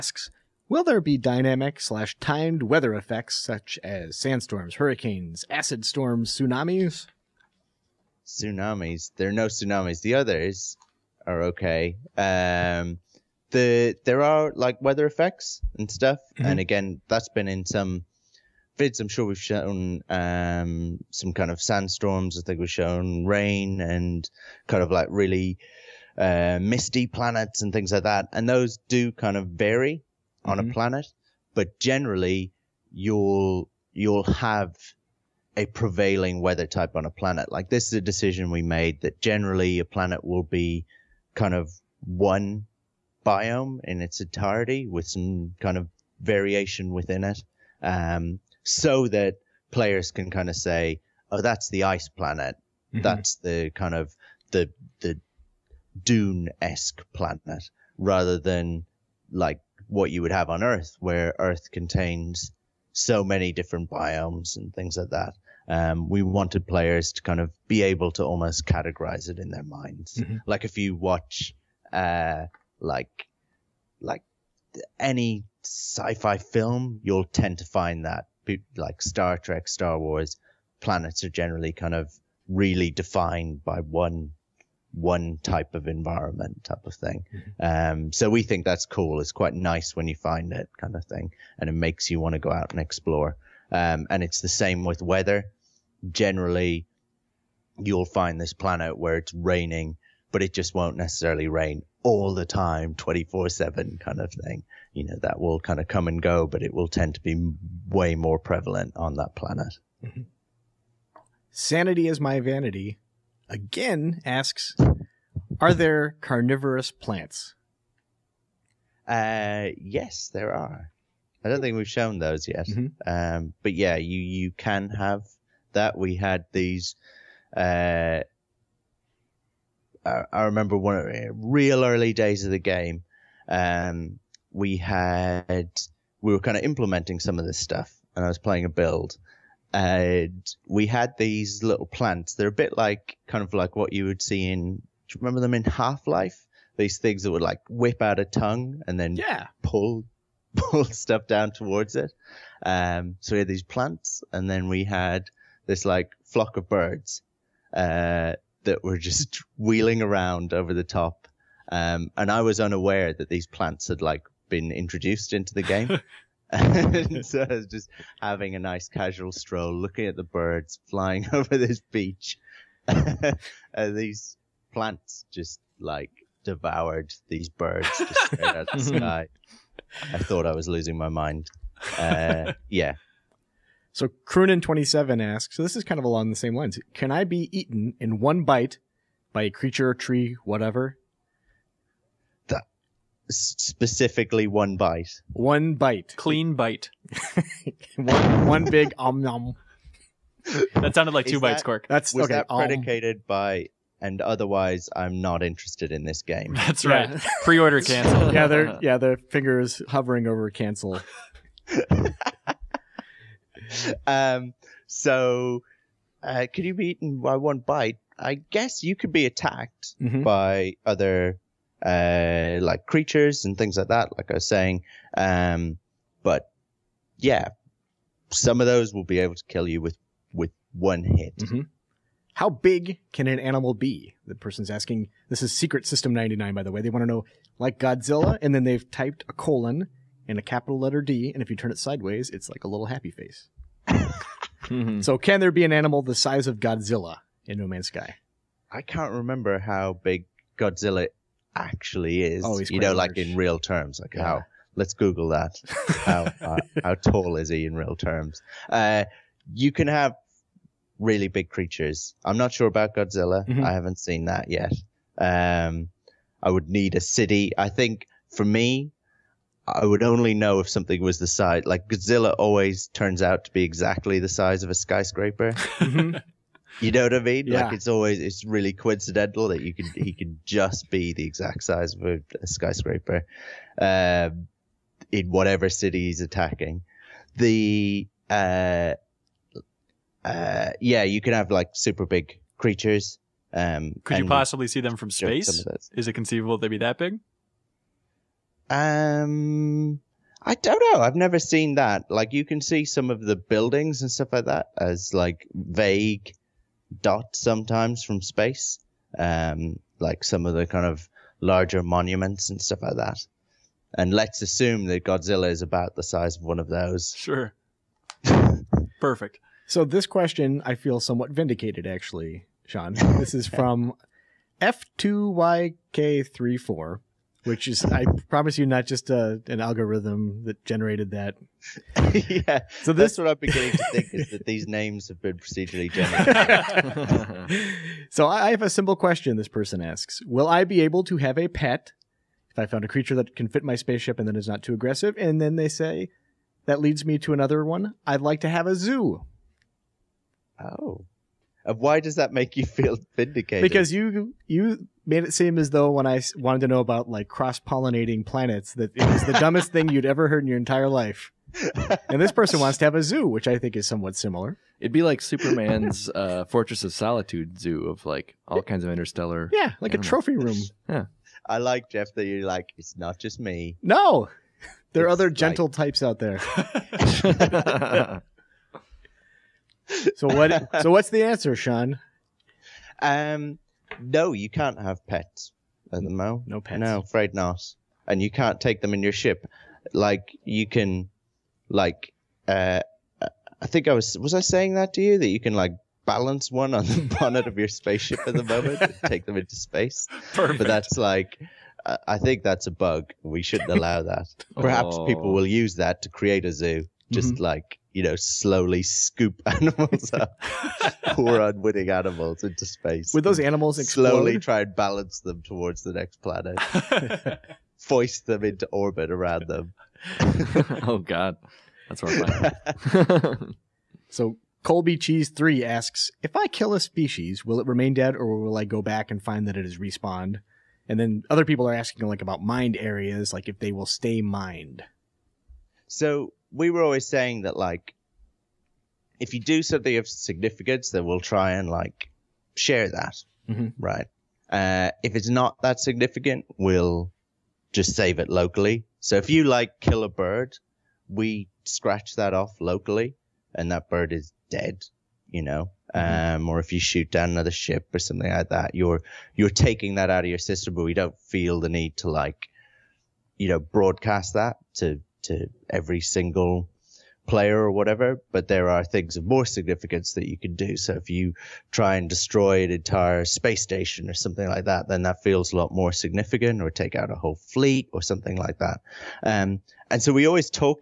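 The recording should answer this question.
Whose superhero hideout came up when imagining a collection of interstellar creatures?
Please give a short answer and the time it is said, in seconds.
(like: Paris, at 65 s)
Superman, at 365 s.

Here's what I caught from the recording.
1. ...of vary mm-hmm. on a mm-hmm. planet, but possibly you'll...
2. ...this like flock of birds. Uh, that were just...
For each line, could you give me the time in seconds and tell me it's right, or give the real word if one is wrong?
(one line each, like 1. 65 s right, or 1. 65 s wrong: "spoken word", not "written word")
1. 29 s wrong: "generally", not "possibly"
2. 155 s right.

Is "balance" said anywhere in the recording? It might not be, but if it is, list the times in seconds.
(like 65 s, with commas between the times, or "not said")
396 s, 414 s.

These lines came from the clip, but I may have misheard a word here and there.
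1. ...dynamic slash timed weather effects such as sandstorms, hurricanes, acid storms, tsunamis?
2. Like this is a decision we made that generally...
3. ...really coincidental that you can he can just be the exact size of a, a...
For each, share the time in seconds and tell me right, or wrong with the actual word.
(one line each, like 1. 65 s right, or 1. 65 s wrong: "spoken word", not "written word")
1. 1 s right
2. 37 s right
3. 278 s right.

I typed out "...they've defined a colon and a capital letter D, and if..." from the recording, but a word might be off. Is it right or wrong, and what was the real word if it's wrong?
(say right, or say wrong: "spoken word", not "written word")
wrong: "typed", not "defined".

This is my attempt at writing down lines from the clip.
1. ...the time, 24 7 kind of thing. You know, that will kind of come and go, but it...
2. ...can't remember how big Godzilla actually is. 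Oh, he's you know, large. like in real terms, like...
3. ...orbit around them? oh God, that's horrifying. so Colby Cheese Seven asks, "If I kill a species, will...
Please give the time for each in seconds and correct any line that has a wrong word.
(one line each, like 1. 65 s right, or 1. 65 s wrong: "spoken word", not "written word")
1. 102 s right
2. 248 s right
3. 418 s wrong: "Three", not "Seven".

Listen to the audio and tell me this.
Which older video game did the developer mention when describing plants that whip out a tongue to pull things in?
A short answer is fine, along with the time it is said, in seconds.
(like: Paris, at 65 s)
Half Life, at 145 s.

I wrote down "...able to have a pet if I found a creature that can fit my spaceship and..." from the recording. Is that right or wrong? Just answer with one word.
right.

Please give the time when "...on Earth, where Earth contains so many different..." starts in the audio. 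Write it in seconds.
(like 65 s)
60 s.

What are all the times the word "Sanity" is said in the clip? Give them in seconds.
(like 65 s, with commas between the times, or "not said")
111 s.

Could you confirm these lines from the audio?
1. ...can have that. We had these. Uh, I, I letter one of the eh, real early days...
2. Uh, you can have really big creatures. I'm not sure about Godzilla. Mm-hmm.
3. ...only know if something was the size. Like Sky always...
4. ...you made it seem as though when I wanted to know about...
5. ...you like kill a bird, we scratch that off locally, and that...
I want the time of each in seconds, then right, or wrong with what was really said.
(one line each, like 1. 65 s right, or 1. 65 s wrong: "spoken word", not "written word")
1. 124 s wrong: "remember", not "letter"
2. 258 s right
3. 270 s wrong: "Godzilla", not "Sky"
4. 354 s right
5. 449 s right.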